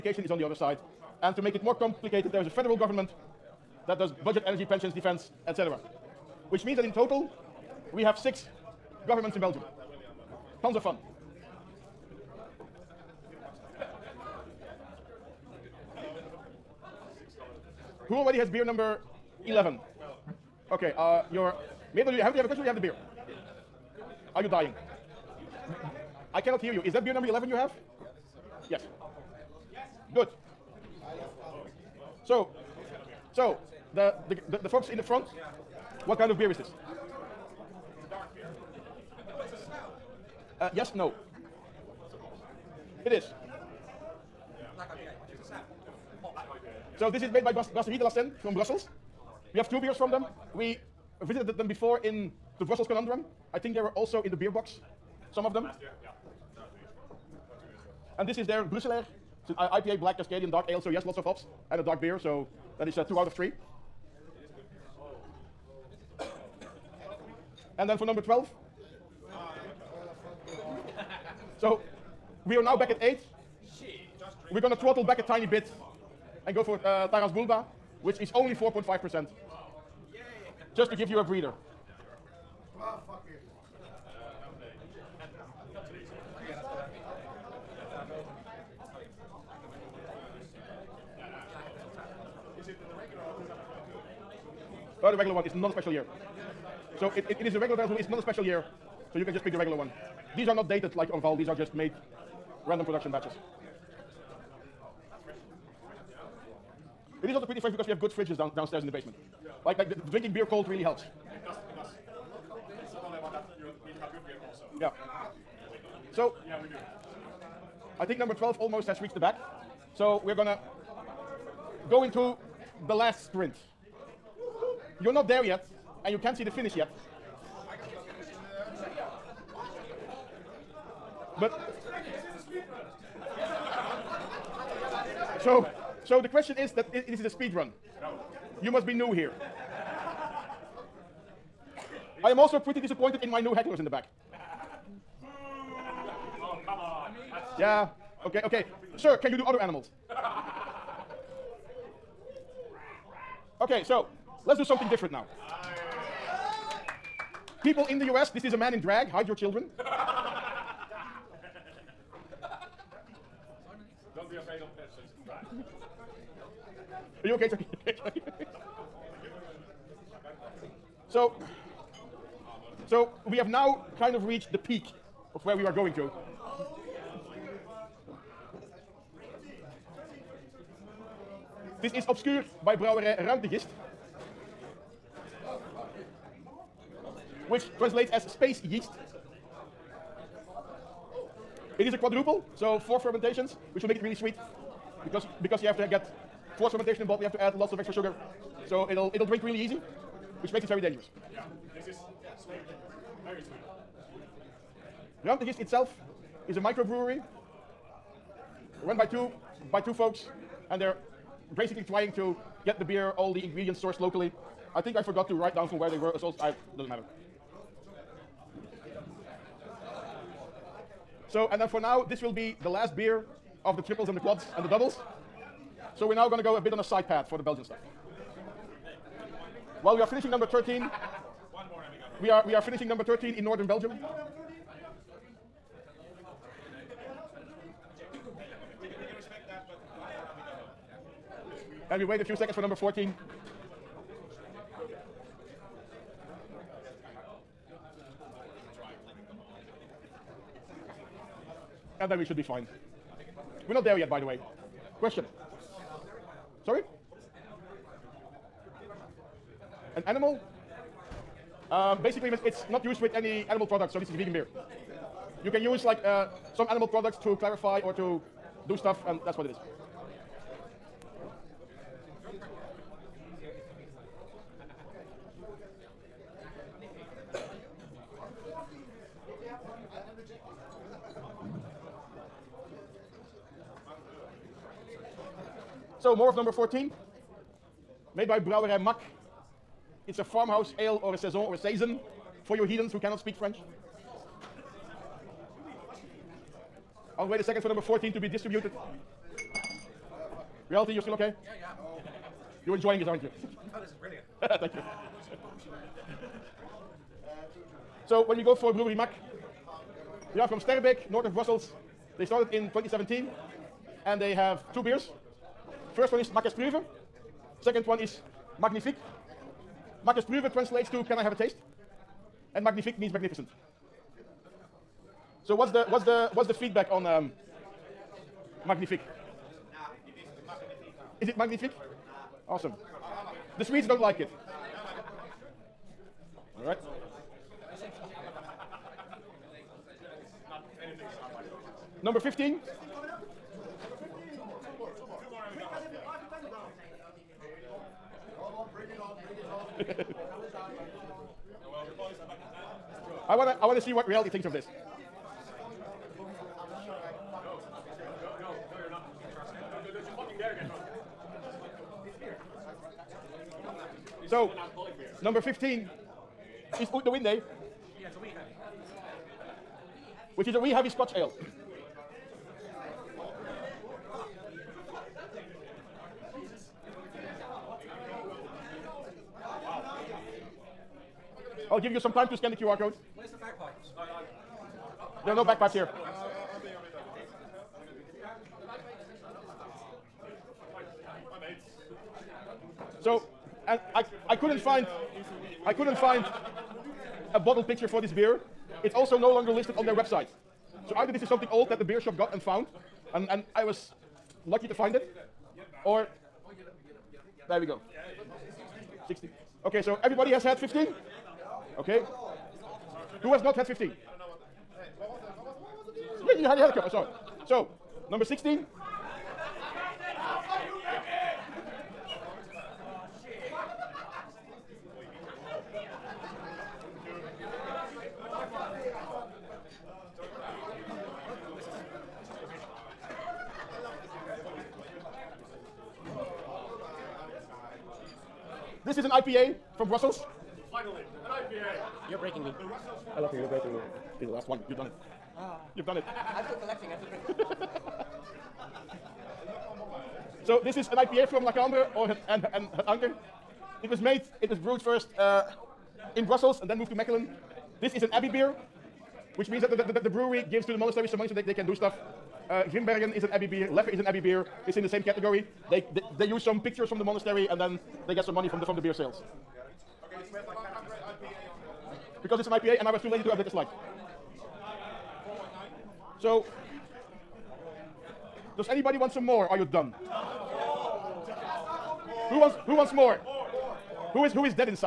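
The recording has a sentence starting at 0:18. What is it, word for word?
Who already has beer number 11?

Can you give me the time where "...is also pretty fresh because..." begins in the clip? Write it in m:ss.
1:47.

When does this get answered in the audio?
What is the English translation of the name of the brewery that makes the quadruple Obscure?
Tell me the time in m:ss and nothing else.
3:08.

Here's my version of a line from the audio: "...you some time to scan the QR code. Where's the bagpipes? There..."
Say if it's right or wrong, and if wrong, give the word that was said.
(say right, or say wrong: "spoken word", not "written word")
right.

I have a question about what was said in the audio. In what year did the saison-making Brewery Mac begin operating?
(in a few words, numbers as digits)
2017.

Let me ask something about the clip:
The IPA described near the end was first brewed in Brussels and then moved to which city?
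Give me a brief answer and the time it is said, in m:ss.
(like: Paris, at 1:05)
Mechelen, at 7:36.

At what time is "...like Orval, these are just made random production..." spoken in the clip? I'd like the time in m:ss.
1:40.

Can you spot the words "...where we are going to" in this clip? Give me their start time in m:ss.
2:55.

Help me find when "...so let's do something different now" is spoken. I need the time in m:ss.
2:33.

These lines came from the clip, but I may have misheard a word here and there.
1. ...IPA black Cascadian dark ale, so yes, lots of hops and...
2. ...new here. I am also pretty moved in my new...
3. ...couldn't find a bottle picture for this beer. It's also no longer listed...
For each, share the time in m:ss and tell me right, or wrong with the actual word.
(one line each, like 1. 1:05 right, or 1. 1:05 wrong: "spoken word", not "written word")
1. 0:59 right
2. 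2:18 wrong: "disappointed", not "moved"
3. 6:35 right.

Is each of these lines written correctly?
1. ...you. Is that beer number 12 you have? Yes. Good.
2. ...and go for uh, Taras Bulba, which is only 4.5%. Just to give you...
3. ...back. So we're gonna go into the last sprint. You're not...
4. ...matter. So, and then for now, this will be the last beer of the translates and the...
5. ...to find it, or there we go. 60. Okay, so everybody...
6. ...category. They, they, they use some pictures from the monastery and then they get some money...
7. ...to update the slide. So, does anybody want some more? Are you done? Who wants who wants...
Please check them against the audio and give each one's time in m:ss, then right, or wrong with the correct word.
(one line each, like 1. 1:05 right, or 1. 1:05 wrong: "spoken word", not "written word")
1. 0:26 wrong: "11", not "12"
2. 1:16 right
3. 1:59 right
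4. 3:36 wrong: "triples", not "translates"
5. 6:44 right
6. 7:45 right
7. 7:53 right.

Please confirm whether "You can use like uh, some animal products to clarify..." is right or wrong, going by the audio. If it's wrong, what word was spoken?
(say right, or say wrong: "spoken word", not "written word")
right.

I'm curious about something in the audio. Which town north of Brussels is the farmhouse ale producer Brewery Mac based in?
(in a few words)
Sterbeek.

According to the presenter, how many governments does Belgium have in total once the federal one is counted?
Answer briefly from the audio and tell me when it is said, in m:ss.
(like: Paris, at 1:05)
6, at 0:08.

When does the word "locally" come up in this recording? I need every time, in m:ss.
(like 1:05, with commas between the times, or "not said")
3:33.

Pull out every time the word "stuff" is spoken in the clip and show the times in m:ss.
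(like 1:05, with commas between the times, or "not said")
3:47, 4:28, 7:41.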